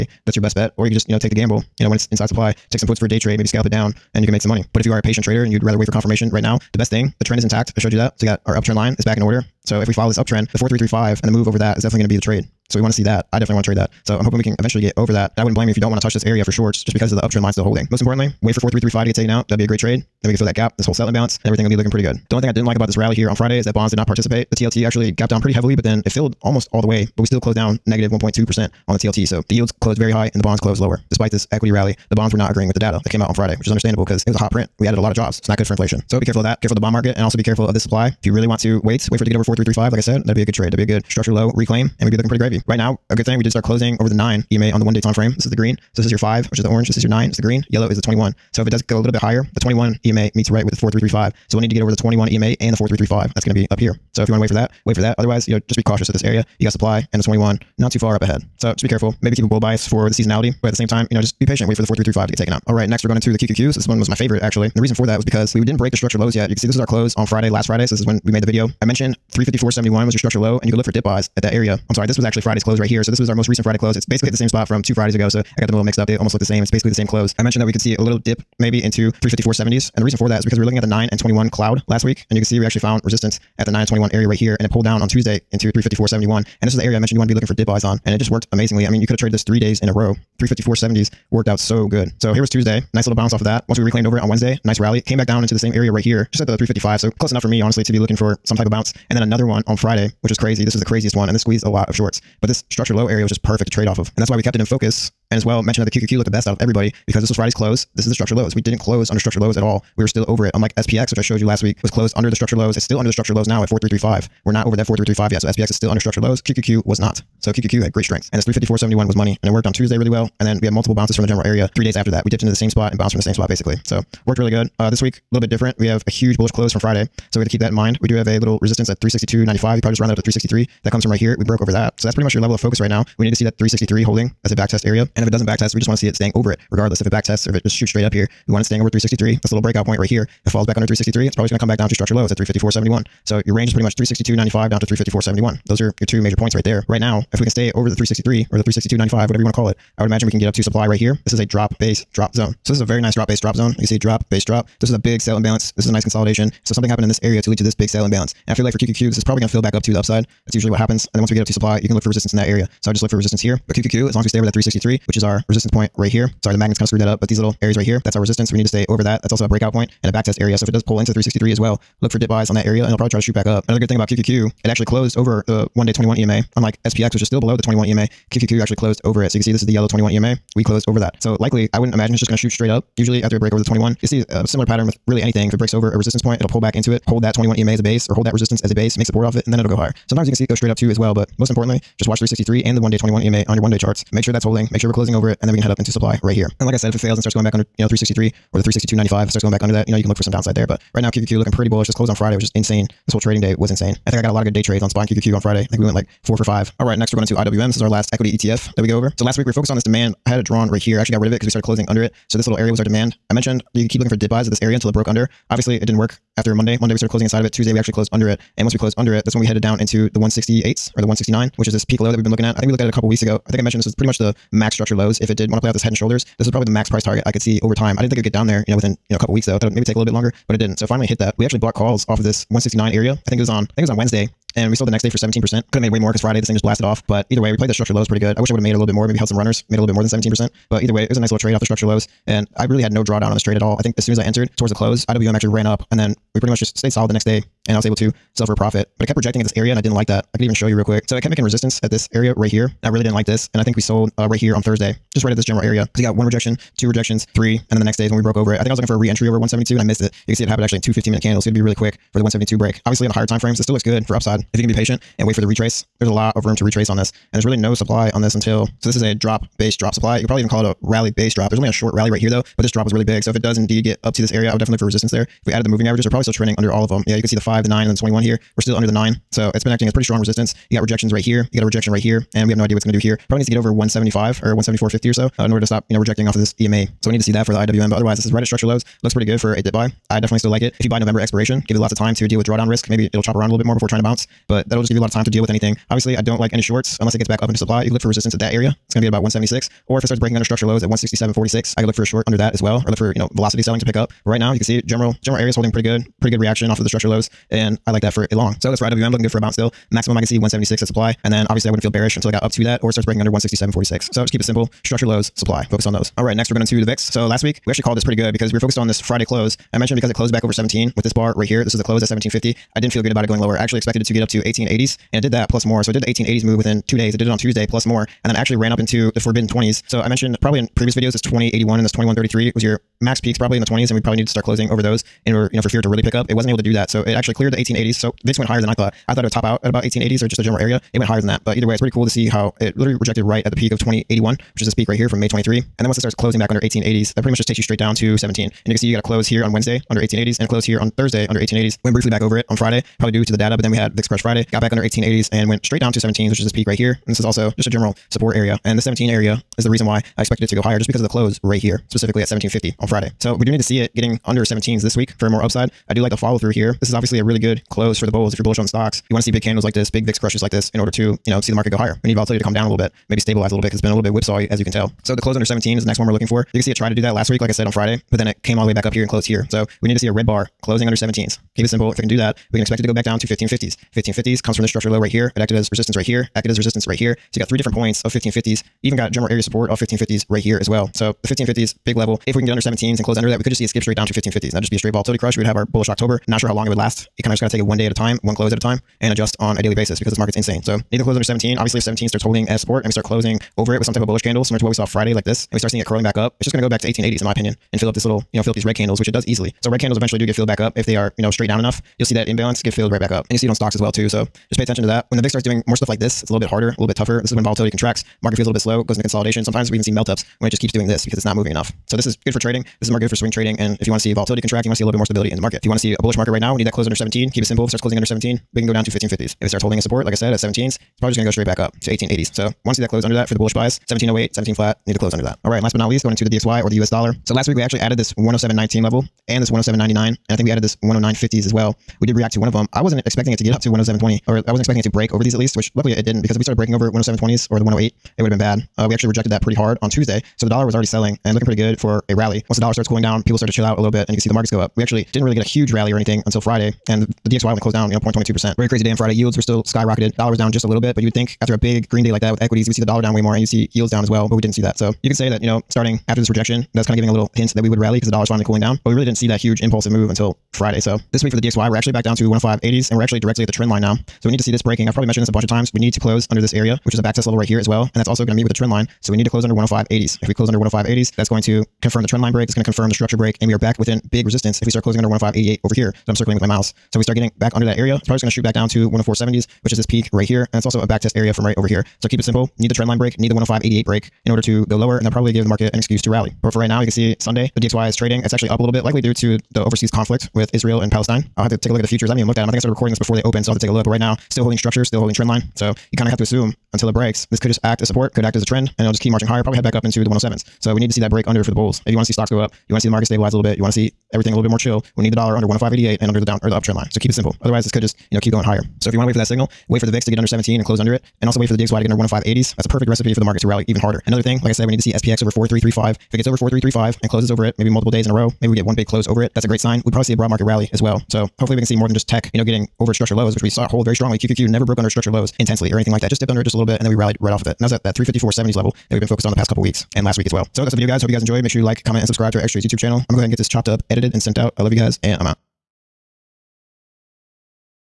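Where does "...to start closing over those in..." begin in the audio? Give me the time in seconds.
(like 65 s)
334 s.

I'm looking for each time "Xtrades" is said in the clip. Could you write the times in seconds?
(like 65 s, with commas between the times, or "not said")
542 s.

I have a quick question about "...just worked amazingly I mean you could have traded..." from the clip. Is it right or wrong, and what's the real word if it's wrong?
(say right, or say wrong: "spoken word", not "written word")
right.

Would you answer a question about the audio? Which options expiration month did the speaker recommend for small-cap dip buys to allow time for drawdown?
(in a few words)
November.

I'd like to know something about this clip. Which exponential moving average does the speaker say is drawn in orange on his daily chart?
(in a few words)
5.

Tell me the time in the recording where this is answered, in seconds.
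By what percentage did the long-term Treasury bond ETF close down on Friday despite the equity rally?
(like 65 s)
27 s.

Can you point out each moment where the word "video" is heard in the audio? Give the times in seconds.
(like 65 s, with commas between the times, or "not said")
68 s, 330 s, 540 s.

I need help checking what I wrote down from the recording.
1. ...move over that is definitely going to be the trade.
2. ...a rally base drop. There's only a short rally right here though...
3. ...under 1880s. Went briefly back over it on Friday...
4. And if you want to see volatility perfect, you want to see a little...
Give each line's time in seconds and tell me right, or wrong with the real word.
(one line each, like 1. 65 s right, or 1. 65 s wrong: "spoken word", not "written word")
1. 11 s right
2. 270 s right
3. 351 s right
4. 423 s wrong: "contract", not "perfect".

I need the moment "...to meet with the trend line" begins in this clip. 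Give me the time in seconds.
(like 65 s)
478 s.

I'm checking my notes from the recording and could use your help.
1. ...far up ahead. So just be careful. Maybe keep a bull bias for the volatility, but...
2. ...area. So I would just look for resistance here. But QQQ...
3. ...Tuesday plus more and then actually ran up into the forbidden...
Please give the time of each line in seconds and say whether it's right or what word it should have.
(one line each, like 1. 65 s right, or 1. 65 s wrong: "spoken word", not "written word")
1. 57 s wrong: "seasonality", not "volatility"
2. 162 s right
3. 327 s right.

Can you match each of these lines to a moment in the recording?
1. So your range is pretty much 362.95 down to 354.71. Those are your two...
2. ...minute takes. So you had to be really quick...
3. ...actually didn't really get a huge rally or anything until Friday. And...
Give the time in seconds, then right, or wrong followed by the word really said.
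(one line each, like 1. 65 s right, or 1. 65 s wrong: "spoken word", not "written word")
1. 143 s right
2. 261 s wrong: "candles", not "takes"
3. 454 s right.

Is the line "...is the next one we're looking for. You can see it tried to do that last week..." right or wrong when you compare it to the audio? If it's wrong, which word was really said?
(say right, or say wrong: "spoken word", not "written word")
right.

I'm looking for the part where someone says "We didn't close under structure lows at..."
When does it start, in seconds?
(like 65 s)
108 s.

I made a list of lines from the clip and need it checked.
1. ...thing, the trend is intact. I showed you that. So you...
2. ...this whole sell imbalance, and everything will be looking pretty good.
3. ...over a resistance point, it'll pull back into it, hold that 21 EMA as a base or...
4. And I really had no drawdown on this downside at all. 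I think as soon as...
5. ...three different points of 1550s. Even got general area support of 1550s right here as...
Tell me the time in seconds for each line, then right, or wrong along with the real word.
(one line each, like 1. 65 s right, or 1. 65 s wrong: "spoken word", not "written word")
1. 6 s right
2. 20 s right
3. 185 s right
4. 242 s wrong: "trade", not "downside"
5. 387 s right.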